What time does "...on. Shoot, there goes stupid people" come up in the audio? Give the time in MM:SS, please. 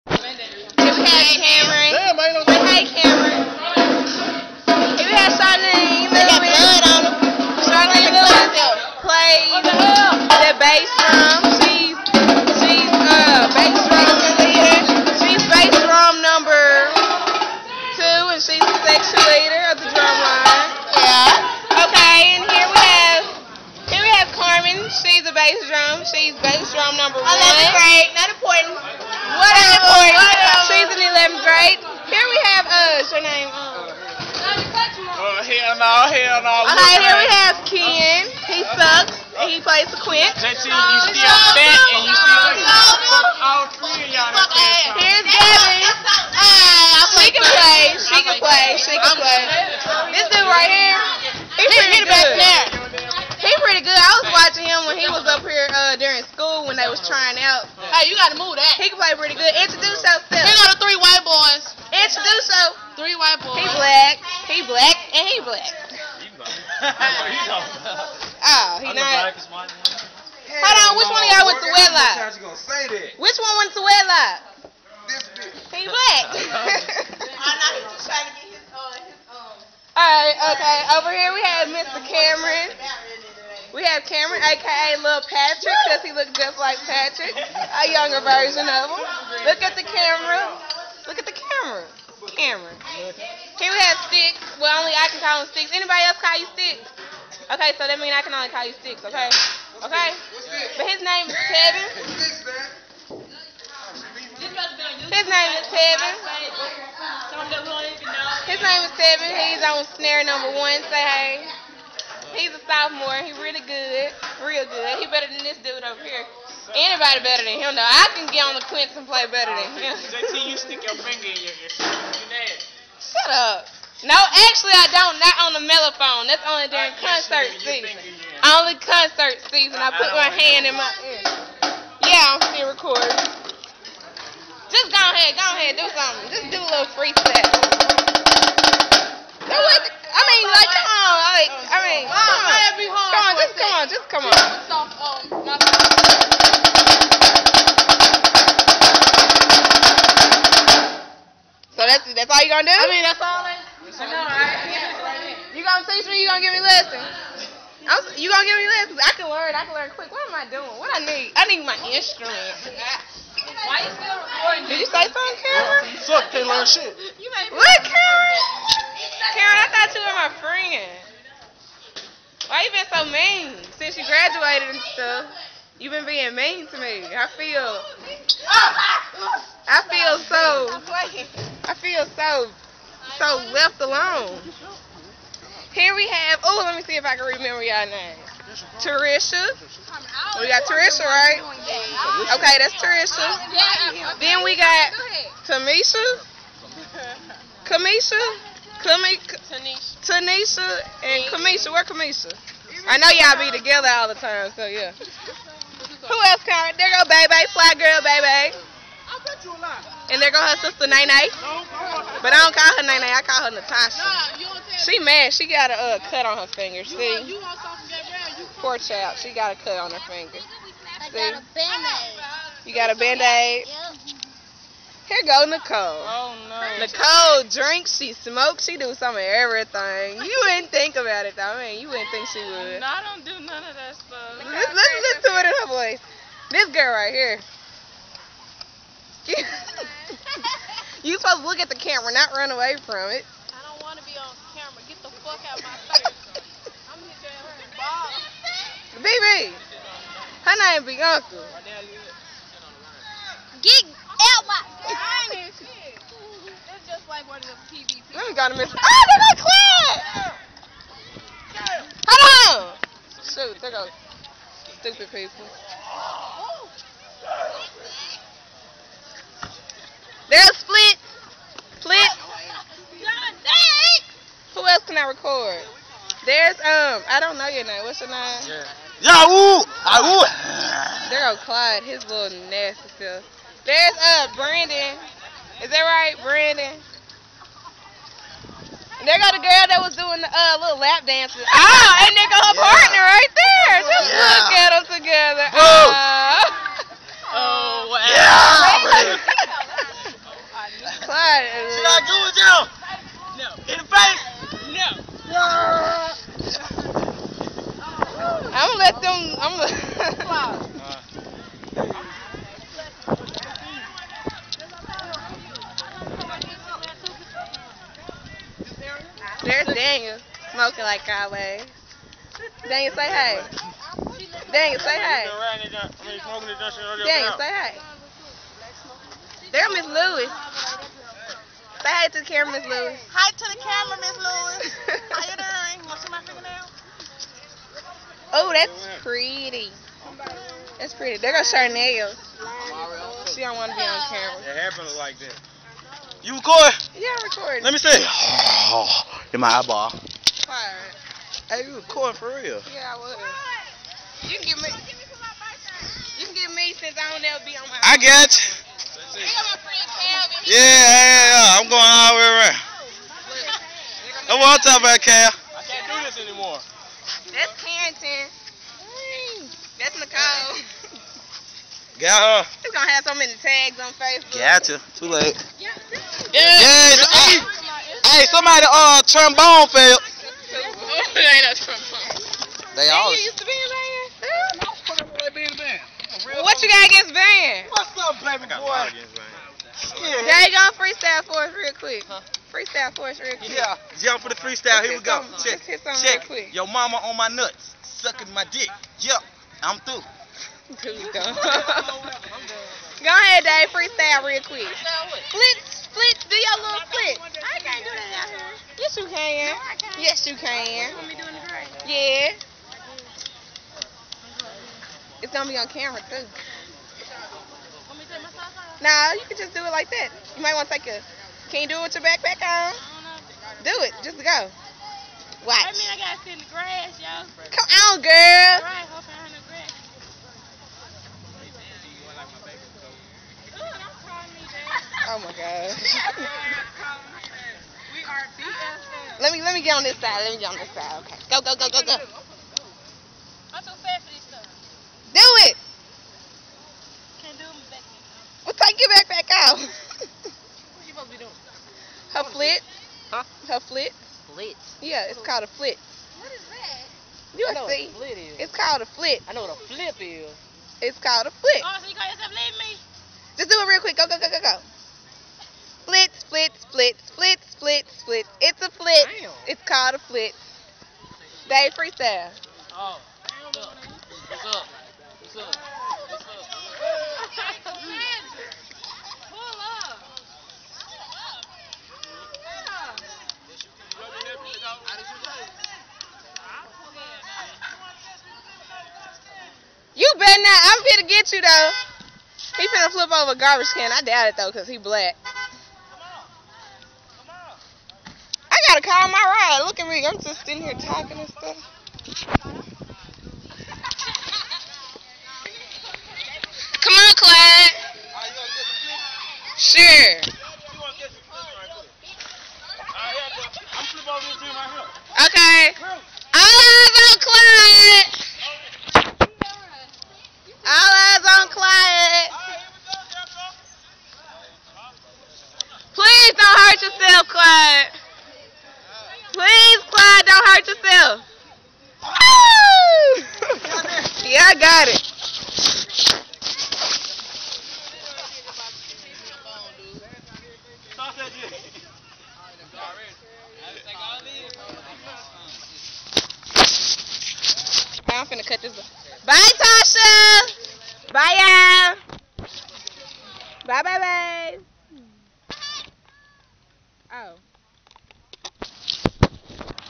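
04:22.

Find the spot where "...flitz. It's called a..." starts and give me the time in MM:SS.
07:48.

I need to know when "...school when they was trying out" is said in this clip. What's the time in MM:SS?
00:56.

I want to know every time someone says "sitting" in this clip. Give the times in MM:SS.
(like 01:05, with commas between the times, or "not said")
08:20.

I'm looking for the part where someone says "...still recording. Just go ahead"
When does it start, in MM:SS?
02:12.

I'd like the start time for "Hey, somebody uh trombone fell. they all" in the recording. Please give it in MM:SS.
06:18.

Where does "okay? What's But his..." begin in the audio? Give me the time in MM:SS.
01:39.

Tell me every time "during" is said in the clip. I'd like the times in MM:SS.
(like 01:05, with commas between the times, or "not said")
00:55, 02:06.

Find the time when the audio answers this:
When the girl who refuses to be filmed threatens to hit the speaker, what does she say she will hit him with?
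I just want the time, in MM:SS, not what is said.
04:09.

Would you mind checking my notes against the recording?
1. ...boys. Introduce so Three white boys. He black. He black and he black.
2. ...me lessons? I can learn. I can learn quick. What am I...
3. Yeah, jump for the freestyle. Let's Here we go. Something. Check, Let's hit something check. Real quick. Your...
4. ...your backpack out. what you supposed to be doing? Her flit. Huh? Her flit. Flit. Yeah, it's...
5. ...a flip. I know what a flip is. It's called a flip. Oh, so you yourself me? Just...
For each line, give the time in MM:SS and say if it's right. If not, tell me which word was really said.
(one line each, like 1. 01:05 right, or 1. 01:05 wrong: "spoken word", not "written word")
1. 01:01 right
2. 02:38 right
3. 06:33 right
4. 07:28 right
5. 07:38 right.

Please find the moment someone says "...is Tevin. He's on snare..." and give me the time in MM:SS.
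01:48.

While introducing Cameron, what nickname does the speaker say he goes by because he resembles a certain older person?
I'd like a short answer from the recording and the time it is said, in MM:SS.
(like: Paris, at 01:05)
Lil Patrick, at 01:24.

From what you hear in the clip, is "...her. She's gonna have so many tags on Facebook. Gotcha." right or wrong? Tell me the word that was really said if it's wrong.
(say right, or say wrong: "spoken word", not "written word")
right.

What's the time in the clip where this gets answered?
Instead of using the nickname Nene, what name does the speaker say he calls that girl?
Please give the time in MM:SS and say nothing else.
03:33.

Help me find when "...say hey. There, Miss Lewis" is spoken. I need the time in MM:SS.
05:27.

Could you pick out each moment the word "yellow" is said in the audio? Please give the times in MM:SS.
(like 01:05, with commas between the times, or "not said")
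not said.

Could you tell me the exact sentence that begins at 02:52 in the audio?
Why you been so mean since you graduated and stuff?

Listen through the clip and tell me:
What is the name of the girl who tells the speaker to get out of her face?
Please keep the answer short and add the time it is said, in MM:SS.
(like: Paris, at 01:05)
Bianca, at 04:10.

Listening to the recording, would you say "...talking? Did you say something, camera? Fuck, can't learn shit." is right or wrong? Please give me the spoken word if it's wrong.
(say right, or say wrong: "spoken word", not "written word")
wrong: "recording", not "talking".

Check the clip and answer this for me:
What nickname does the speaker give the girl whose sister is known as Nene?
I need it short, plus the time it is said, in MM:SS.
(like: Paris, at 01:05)
Fly Girl Baby, at 03:27.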